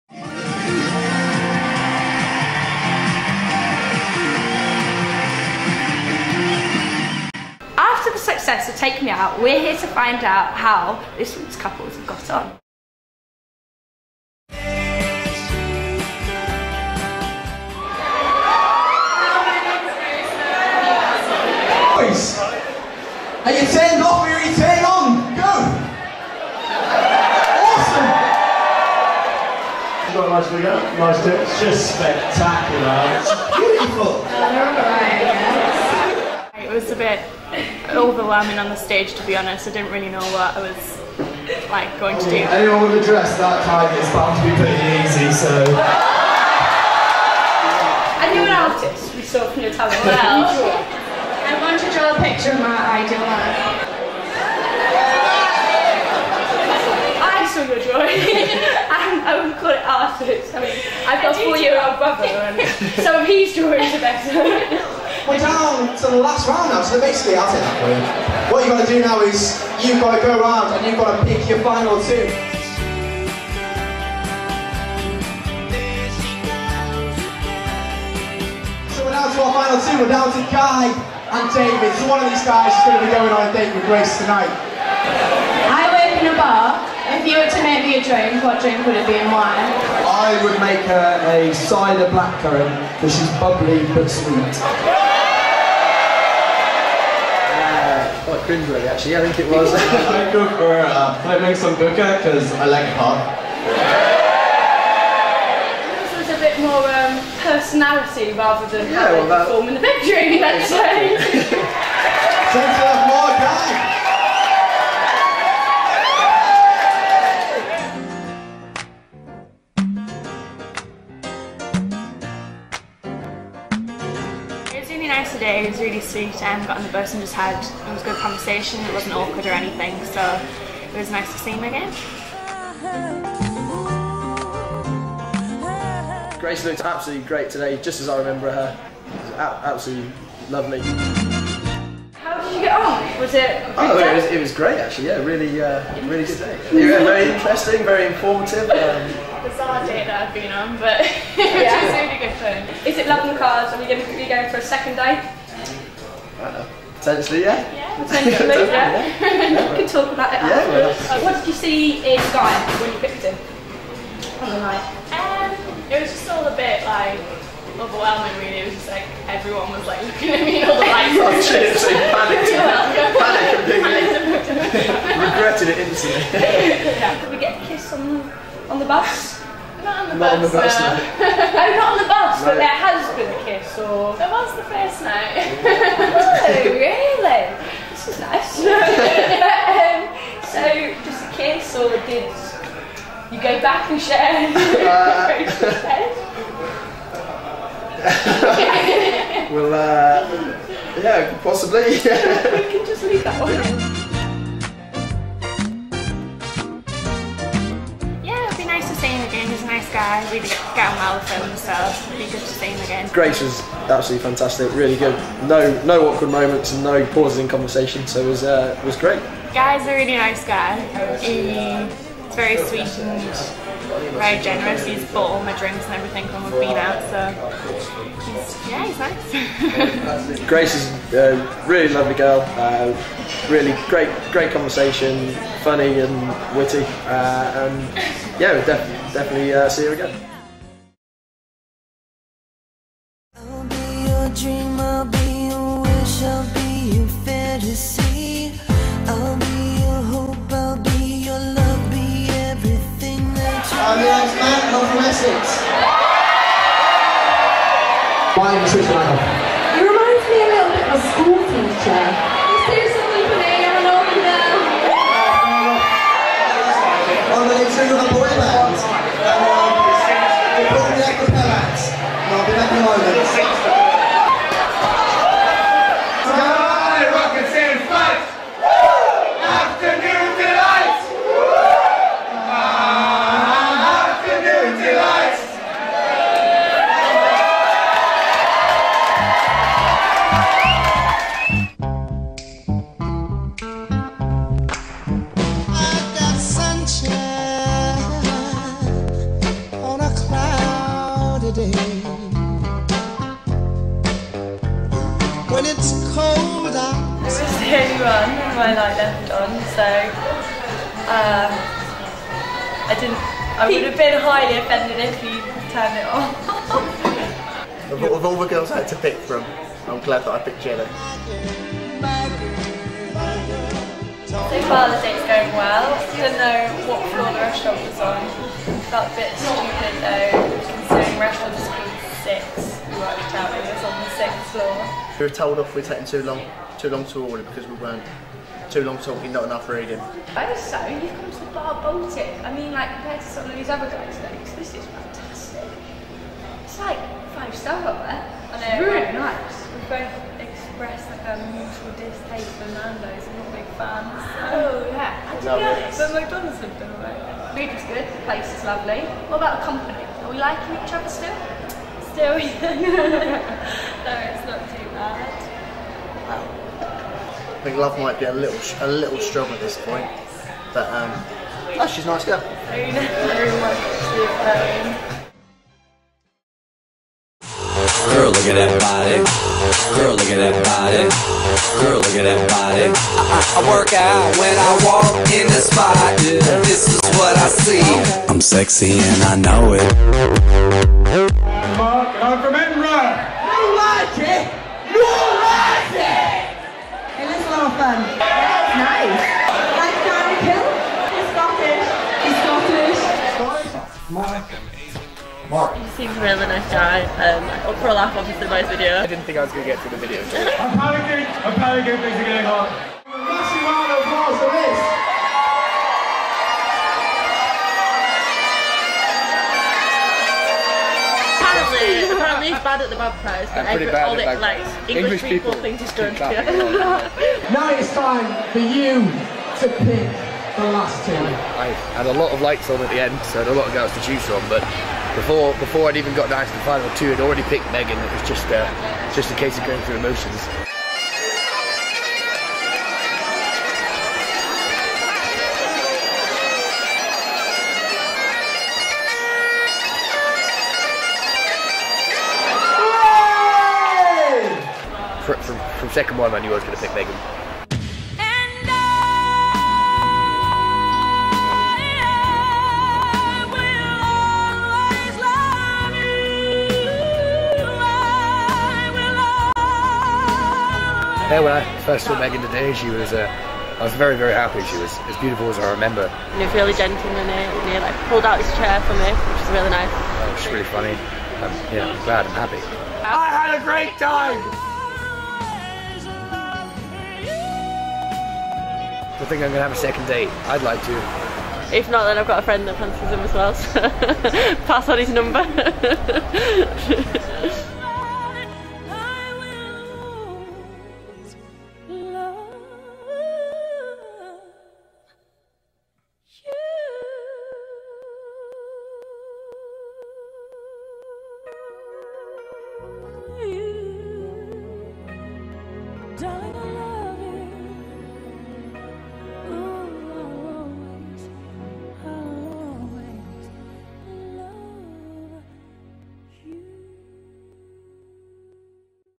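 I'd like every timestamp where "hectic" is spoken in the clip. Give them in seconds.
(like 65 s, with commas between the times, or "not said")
not said.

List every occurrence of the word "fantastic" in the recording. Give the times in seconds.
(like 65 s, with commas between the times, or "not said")
214 s, 344 s.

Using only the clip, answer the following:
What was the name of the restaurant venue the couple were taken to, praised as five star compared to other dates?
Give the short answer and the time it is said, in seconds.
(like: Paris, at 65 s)
Bar Baltic, at 341 s.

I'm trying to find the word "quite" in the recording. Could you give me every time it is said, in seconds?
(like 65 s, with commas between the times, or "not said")
98 s.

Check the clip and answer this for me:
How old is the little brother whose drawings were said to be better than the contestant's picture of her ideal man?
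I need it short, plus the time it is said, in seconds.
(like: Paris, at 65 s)
4, at 61 s.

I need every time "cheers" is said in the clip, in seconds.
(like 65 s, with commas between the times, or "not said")
171 s.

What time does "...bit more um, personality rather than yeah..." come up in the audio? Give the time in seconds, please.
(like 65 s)
106 s.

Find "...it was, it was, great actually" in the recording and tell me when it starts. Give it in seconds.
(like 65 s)
143 s.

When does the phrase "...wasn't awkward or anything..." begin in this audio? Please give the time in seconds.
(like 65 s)
128 s.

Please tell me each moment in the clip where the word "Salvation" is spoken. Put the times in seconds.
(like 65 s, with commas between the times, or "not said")
not said.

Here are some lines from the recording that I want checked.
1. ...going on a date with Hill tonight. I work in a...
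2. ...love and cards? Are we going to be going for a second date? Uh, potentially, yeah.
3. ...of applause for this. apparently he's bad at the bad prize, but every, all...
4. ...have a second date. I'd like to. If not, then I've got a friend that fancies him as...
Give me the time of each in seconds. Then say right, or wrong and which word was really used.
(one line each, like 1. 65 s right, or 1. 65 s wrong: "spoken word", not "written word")
1. 83 s wrong: "Grace", not "Hill"
2. 153 s right
3. 413 s right
4. 489 s right.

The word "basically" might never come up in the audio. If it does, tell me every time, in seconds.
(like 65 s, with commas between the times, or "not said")
66 s.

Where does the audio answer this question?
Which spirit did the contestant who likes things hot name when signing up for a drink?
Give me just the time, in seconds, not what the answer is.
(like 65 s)
101 s.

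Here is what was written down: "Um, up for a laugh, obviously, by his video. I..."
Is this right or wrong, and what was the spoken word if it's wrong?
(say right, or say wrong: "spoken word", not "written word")
right.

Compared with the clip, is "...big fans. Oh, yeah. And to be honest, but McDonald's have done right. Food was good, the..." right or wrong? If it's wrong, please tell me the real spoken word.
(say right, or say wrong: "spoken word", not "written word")
right.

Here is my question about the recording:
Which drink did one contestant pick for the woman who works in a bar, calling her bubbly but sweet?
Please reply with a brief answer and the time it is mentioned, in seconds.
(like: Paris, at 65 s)
Cider blackcurrant, at 91 s.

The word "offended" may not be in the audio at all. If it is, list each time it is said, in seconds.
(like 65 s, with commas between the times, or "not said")
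314 s.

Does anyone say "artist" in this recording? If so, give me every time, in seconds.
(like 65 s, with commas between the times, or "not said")
48 s, 59 s.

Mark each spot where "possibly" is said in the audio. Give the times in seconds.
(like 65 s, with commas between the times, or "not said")
201 s.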